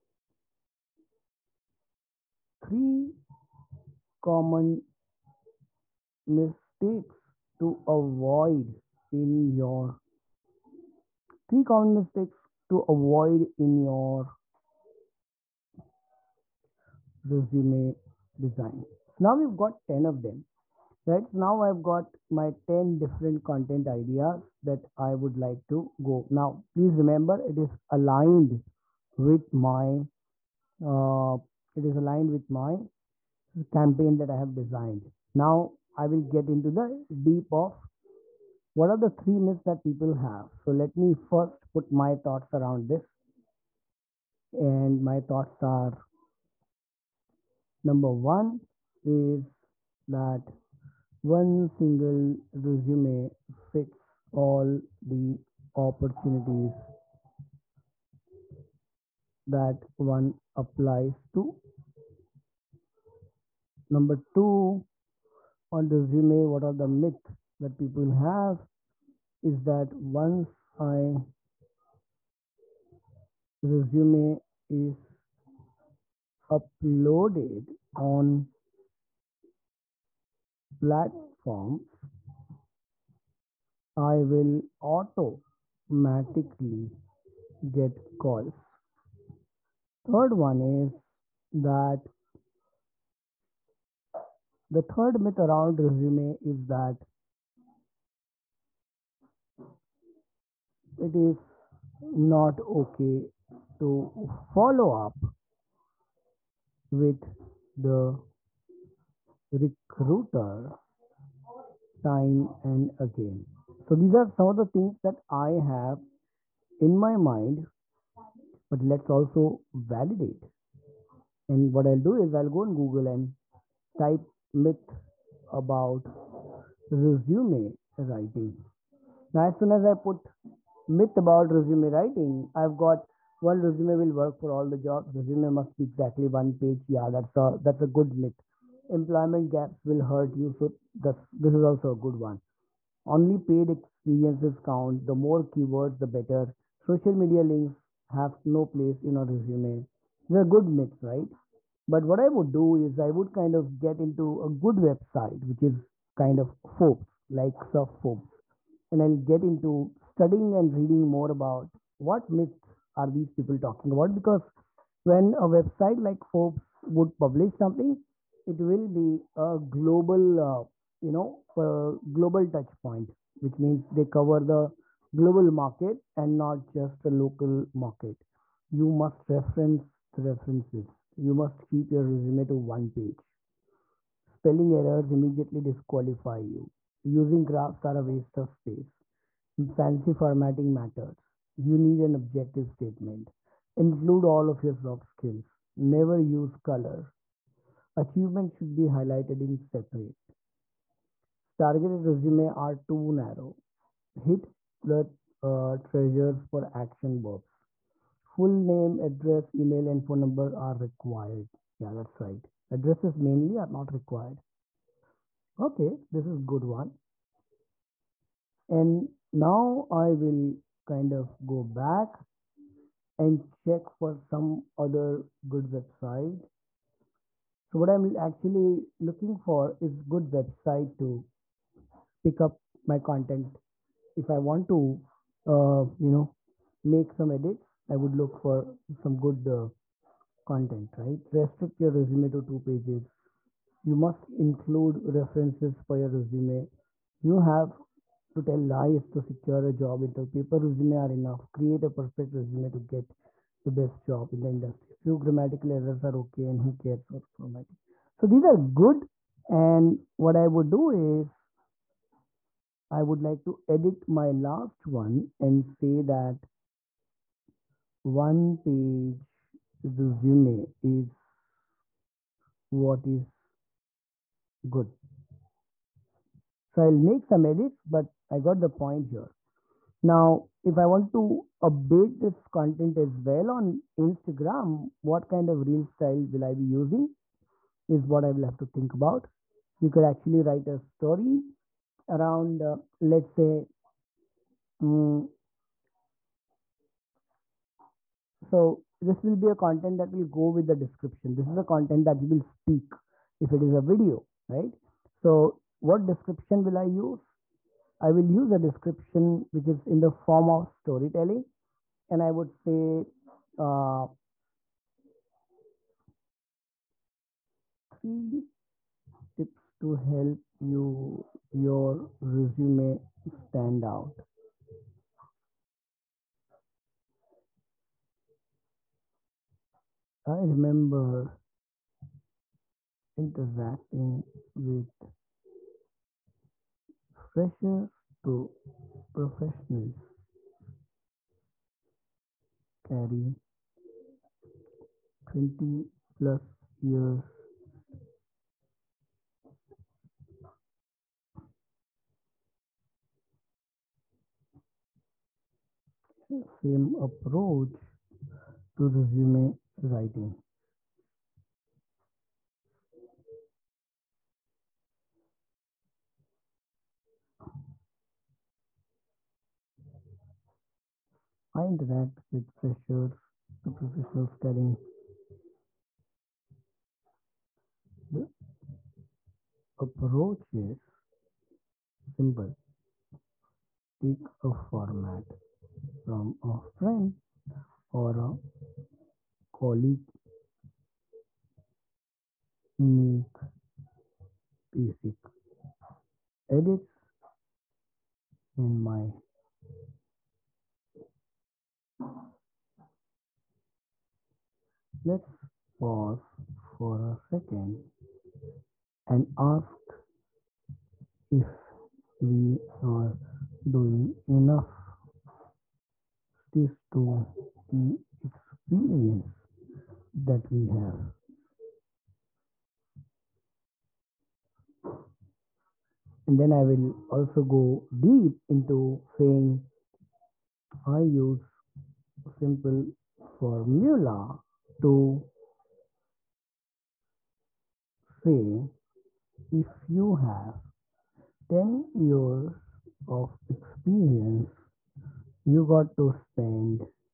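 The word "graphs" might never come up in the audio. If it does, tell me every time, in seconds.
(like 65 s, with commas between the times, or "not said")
187 s.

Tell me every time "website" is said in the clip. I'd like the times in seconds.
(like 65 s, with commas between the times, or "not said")
154 s, 165 s, 225 s, 230 s.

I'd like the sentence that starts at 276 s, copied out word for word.
So I'll make some edits, but I got the point here.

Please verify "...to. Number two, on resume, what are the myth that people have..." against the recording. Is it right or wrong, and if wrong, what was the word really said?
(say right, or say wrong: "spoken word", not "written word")
right.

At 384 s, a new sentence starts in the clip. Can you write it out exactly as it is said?
Take a format from a friend or a colleague.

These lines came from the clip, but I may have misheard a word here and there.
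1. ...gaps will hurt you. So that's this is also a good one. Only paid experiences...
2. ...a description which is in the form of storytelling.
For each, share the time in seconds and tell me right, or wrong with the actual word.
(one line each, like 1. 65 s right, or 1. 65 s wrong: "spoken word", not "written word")
1. 139 s right
2. 308 s right.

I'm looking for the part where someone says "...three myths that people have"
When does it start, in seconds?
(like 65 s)
39 s.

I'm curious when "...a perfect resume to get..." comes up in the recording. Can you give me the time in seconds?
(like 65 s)
251 s.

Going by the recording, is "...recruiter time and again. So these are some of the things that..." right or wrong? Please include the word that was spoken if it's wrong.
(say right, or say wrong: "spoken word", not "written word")
right.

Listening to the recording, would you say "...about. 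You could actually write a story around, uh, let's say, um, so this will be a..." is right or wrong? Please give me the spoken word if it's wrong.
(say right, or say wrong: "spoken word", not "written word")
right.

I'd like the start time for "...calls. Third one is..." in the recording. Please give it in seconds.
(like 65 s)
88 s.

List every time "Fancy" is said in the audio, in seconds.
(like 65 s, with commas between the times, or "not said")
189 s.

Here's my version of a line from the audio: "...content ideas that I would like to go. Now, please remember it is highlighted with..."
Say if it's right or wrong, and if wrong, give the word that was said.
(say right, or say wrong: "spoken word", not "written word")
wrong: "aligned", not "highlighted".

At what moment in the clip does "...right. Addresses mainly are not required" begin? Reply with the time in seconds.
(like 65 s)
212 s.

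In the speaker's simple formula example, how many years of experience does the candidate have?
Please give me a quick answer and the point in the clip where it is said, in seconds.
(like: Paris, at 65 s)
10 years, at 441 s.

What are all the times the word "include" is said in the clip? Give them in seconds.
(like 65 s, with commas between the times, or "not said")
193 s, 244 s.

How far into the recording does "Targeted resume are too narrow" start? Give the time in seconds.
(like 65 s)
201 s.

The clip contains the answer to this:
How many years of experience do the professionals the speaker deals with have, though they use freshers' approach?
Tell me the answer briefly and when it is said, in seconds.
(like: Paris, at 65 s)
20 plus years, at 345 s.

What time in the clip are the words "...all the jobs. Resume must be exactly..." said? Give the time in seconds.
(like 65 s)
134 s.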